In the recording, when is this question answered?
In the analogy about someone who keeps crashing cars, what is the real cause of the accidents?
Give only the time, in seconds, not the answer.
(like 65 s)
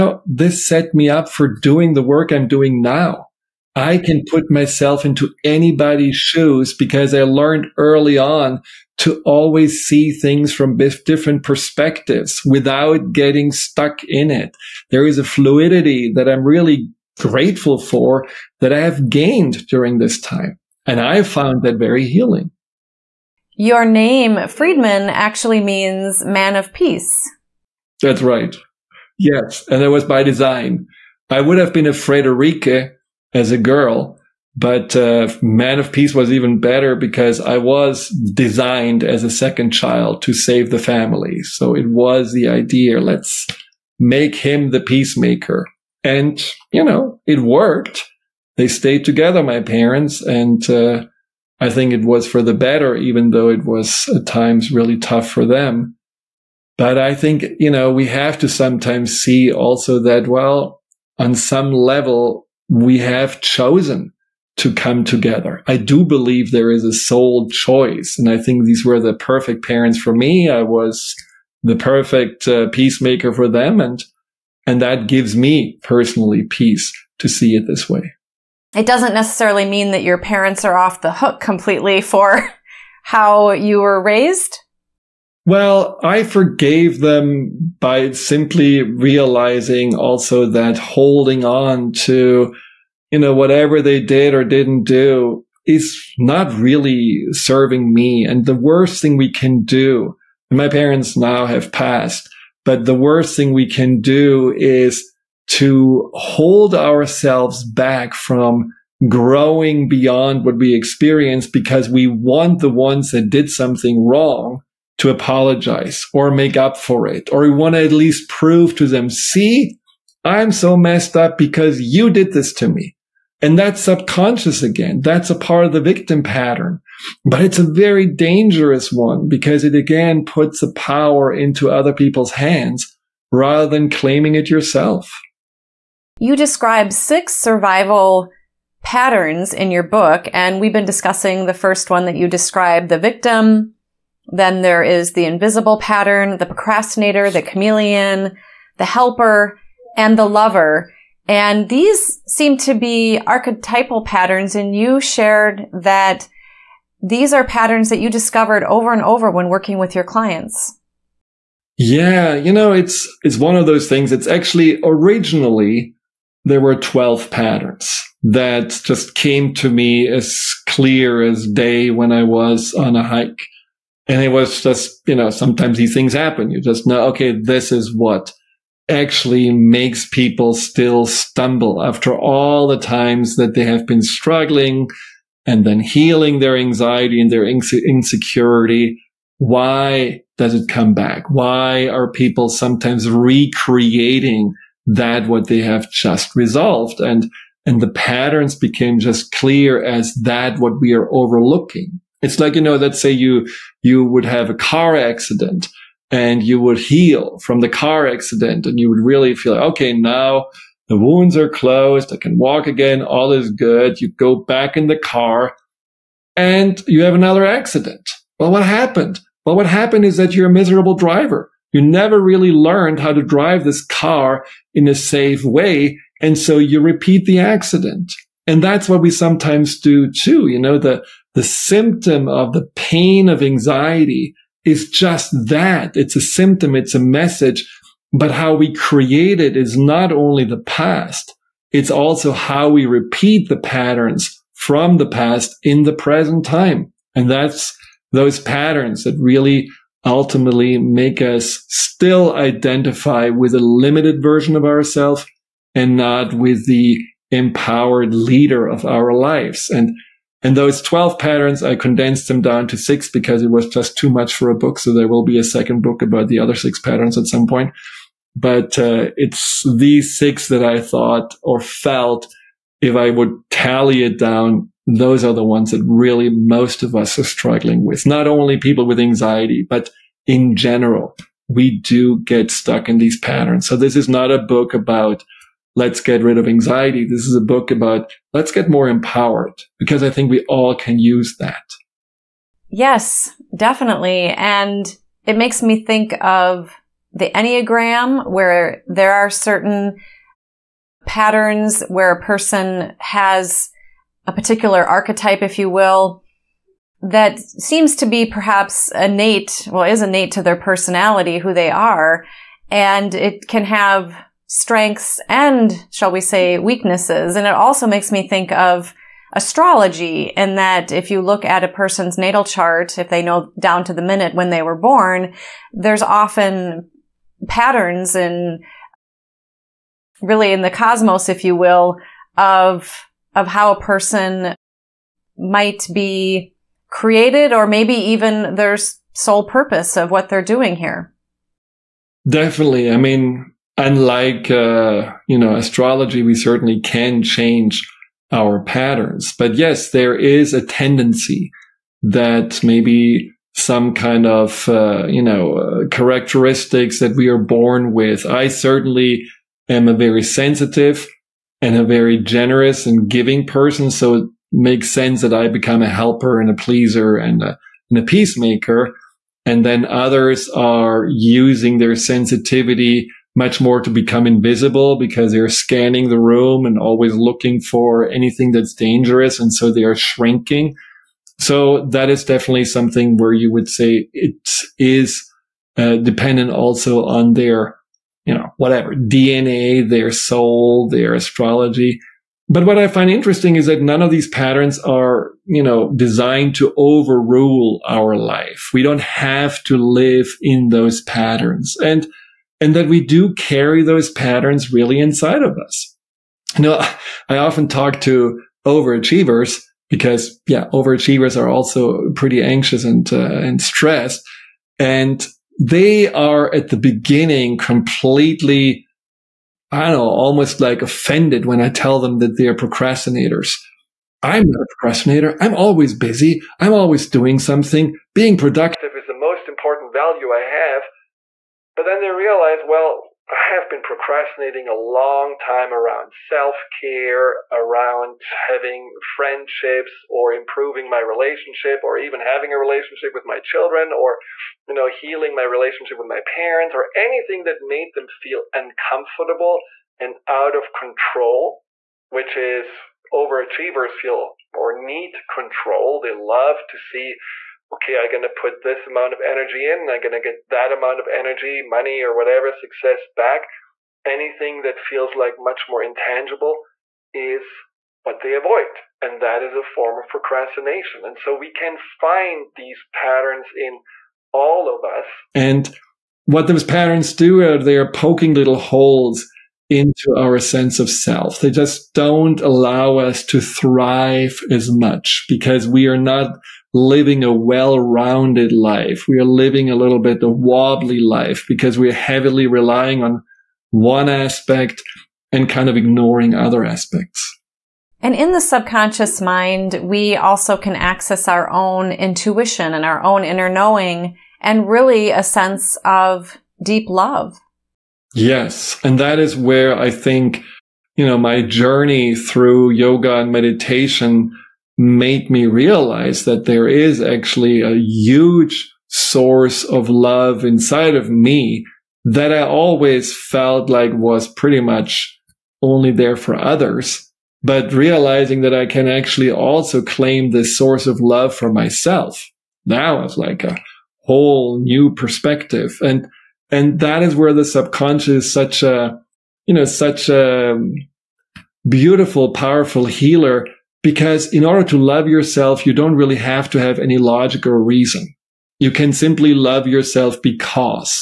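220 s.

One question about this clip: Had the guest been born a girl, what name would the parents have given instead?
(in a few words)
Friederike.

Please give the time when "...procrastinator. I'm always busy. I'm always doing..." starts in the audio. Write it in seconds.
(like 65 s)
424 s.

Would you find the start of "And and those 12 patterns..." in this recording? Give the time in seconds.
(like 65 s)
259 s.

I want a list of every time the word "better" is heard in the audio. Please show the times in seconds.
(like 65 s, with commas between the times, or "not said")
36 s, 52 s.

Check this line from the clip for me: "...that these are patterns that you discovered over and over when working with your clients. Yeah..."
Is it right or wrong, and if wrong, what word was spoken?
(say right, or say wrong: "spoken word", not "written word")
right.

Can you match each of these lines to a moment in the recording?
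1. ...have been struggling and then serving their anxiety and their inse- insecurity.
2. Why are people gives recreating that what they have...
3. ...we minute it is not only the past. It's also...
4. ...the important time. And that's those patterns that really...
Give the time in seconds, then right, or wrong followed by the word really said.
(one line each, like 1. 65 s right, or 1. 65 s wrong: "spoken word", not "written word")
1. 183 s wrong: "healing", not "serving"
2. 191 s wrong: "sometimes", not "gives"
3. 238 s wrong: "create", not "minute"
4. 245 s wrong: "present", not "important".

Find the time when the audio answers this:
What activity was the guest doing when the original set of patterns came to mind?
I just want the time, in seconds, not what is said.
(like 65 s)
172 s.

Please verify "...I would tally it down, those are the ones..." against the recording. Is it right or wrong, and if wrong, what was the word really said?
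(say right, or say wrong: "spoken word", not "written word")
right.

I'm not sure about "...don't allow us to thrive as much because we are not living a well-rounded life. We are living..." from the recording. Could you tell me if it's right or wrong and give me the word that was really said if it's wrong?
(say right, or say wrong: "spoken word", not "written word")
right.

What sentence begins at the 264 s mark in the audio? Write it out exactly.
So there will be a second book about the other six patterns at some point.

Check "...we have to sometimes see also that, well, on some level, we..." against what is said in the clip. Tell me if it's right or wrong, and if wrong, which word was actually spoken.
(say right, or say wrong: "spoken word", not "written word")
right.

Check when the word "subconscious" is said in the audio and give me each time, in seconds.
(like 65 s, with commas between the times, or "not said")
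123 s, 498 s, 537 s.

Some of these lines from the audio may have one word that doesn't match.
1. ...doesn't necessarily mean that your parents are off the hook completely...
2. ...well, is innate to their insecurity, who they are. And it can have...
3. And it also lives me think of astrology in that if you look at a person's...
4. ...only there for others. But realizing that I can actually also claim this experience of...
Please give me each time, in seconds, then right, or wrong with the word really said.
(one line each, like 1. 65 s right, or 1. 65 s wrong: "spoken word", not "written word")
1. 78 s right
2. 309 s wrong: "personality", not "insecurity"
3. 317 s wrong: "makes", not "lives"
4. 525 s wrong: "source", not "experience".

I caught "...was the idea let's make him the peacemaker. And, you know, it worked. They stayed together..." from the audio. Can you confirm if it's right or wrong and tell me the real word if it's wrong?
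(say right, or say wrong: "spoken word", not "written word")
right.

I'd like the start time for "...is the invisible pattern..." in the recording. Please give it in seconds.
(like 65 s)
144 s.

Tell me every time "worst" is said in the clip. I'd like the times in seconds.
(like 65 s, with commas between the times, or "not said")
98 s, 102 s.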